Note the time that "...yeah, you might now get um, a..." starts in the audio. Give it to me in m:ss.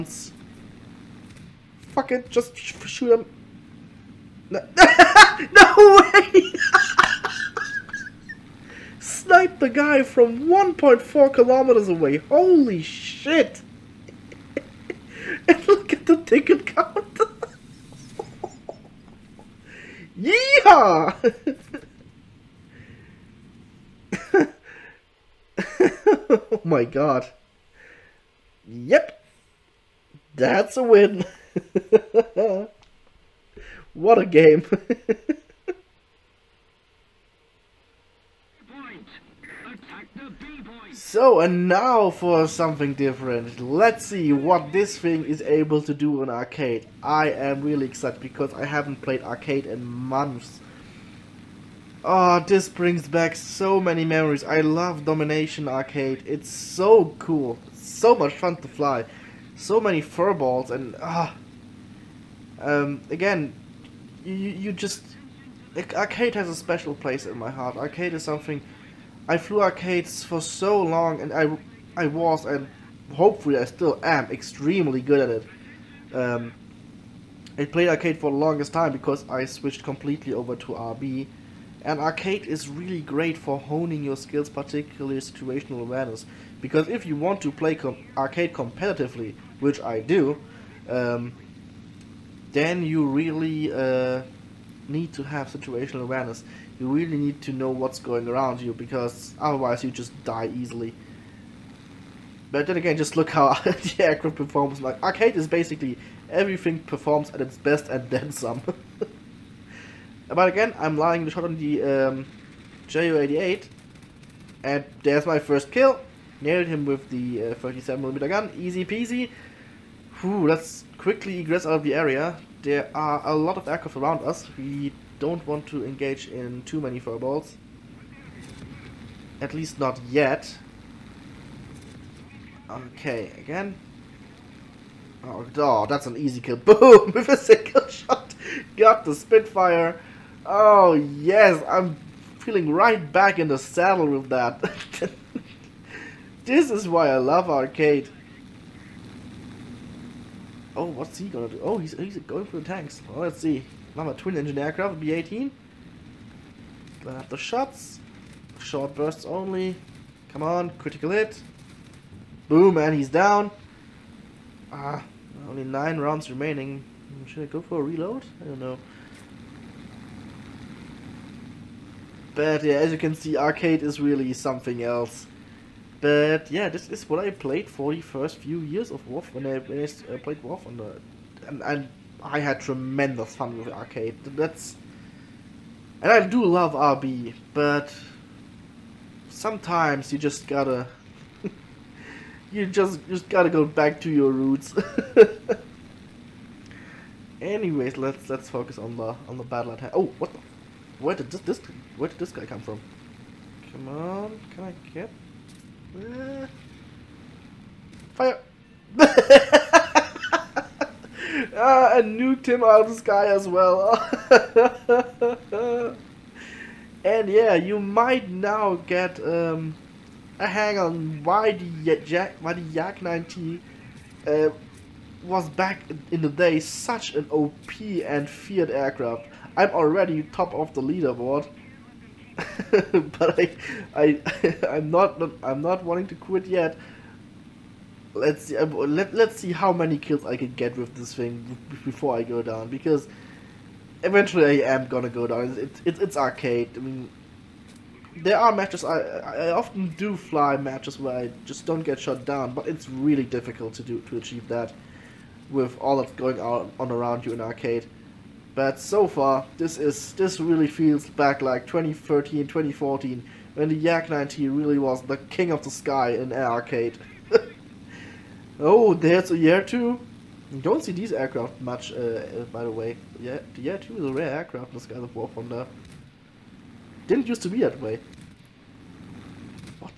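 3:37.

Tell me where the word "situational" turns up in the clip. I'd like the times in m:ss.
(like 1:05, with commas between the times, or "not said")
1:25, 1:35.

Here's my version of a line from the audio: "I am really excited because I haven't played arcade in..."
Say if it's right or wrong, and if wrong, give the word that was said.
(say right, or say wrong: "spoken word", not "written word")
right.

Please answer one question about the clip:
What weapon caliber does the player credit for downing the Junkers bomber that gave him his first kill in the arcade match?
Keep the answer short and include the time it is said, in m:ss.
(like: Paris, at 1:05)
37mm, at 1:57.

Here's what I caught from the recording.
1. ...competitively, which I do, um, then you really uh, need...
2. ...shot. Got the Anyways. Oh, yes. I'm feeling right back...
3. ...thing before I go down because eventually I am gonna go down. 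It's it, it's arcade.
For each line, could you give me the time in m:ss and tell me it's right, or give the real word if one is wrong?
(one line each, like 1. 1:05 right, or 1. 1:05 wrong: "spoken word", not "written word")
1. 1:28 right
2. 2:17 wrong: "Spitfire", not "Anyways"
3. 4:01 right.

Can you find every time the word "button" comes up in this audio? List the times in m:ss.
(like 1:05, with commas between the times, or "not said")
not said.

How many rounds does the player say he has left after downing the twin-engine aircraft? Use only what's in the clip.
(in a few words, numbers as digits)
9.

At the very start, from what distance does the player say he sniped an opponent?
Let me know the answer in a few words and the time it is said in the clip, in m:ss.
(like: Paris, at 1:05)
1.4 kilometers, at 0:10.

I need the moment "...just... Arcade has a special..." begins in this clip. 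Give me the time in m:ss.
1:04.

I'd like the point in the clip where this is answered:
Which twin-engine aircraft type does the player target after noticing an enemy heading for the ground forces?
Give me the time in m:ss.
2:35.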